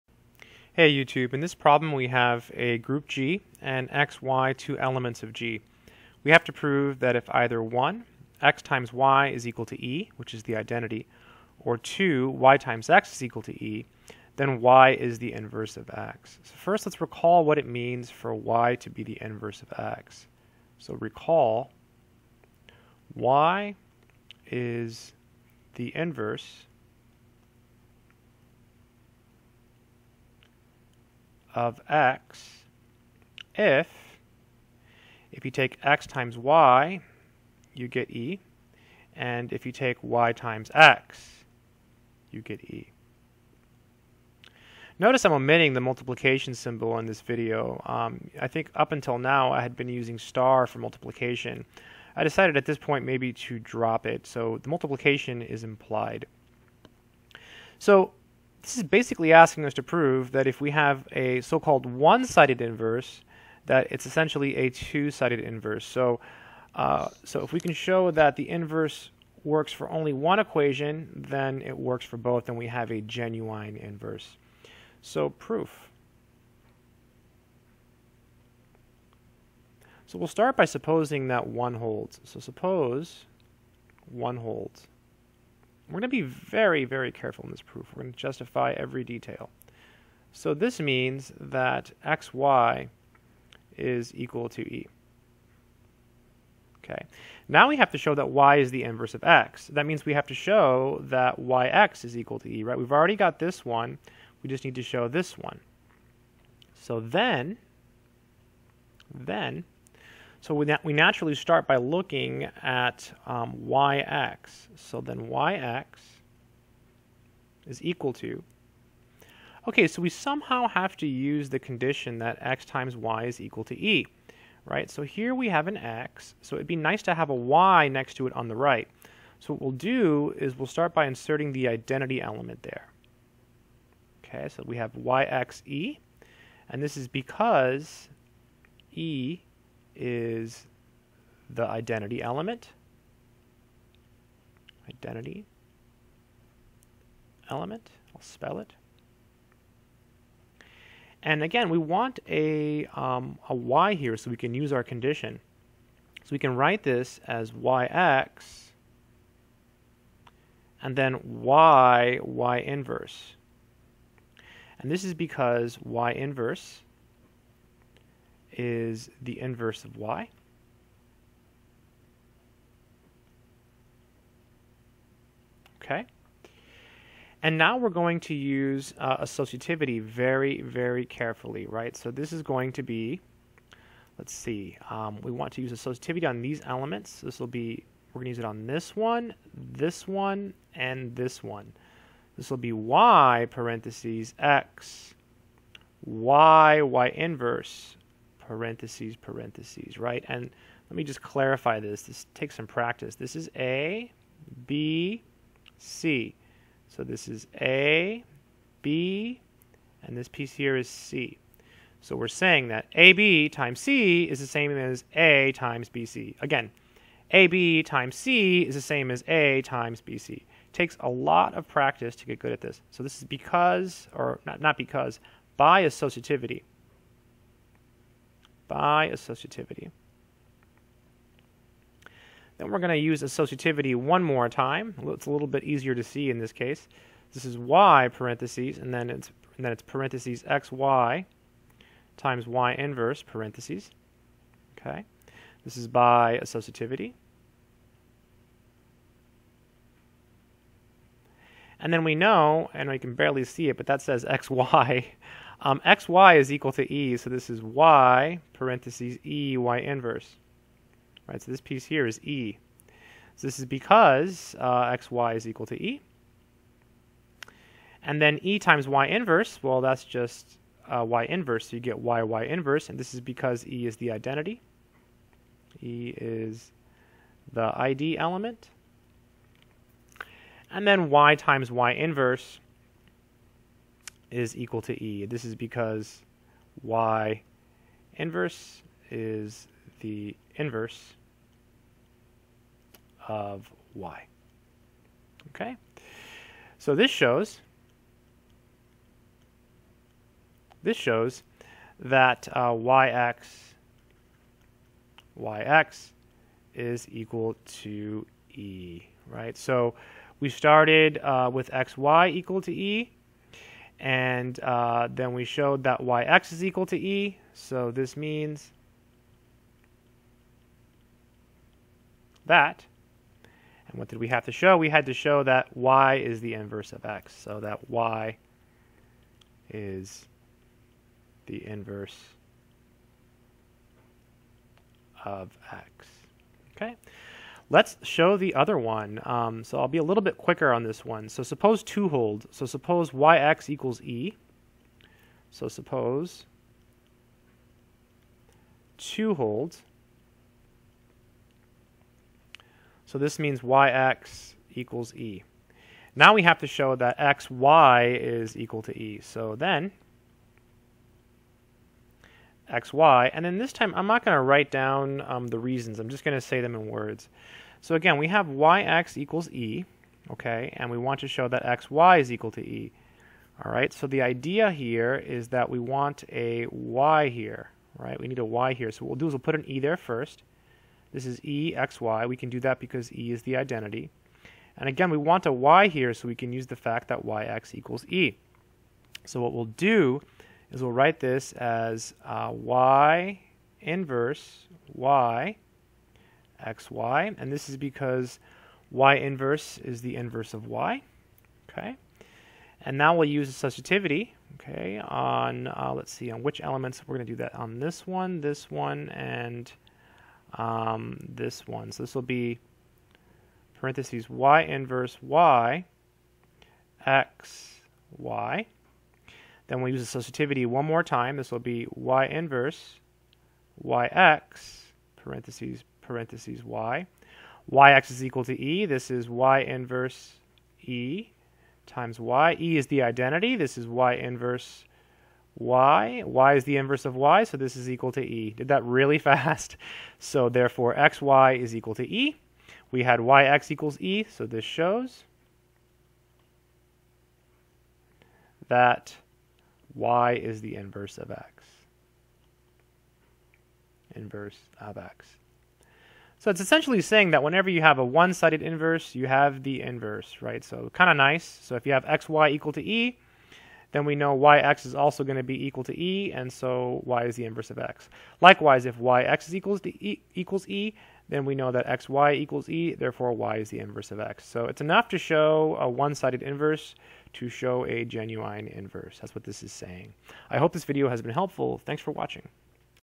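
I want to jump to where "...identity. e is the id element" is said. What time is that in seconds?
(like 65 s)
274 s.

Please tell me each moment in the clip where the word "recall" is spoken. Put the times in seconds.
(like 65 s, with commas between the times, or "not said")
17 s, 21 s.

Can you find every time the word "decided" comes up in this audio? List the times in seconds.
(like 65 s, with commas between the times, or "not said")
52 s.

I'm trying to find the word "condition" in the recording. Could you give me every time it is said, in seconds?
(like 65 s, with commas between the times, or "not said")
121 s, 154 s.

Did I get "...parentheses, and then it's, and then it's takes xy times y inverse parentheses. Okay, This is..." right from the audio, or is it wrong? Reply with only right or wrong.
wrong.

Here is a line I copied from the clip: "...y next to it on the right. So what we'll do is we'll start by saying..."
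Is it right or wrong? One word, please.
wrong.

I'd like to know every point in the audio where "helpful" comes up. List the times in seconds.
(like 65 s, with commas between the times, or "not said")
481 s.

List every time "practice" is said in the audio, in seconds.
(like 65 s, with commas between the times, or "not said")
202 s, 221 s.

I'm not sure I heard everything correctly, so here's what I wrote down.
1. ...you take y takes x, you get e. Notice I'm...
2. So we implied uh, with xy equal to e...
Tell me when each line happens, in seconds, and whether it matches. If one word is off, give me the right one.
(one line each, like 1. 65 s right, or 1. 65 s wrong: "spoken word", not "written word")
1. 39 s wrong: "times", not "takes"
2. 309 s wrong: "started", not "implied".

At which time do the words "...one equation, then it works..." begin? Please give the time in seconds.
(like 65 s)
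70 s.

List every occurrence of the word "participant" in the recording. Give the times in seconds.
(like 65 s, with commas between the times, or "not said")
not said.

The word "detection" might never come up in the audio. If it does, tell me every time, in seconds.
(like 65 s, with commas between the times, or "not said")
not said.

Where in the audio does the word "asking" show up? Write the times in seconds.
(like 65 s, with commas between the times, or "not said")
59 s.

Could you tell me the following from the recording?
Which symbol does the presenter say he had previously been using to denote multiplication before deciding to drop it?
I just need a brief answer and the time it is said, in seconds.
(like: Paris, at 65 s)
star, at 50 s.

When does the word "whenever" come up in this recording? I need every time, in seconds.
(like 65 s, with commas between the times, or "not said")
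457 s.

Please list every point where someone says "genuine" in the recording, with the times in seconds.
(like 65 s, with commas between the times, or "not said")
73 s, 478 s.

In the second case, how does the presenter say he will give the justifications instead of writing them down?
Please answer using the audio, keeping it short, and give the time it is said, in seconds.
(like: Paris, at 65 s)
in words, at 366 s.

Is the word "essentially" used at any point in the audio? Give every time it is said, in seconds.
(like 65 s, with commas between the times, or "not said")
64 s, 456 s.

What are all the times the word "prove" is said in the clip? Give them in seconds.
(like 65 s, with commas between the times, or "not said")
6 s, 59 s.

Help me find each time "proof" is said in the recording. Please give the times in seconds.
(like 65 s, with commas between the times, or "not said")
75 s, 87 s.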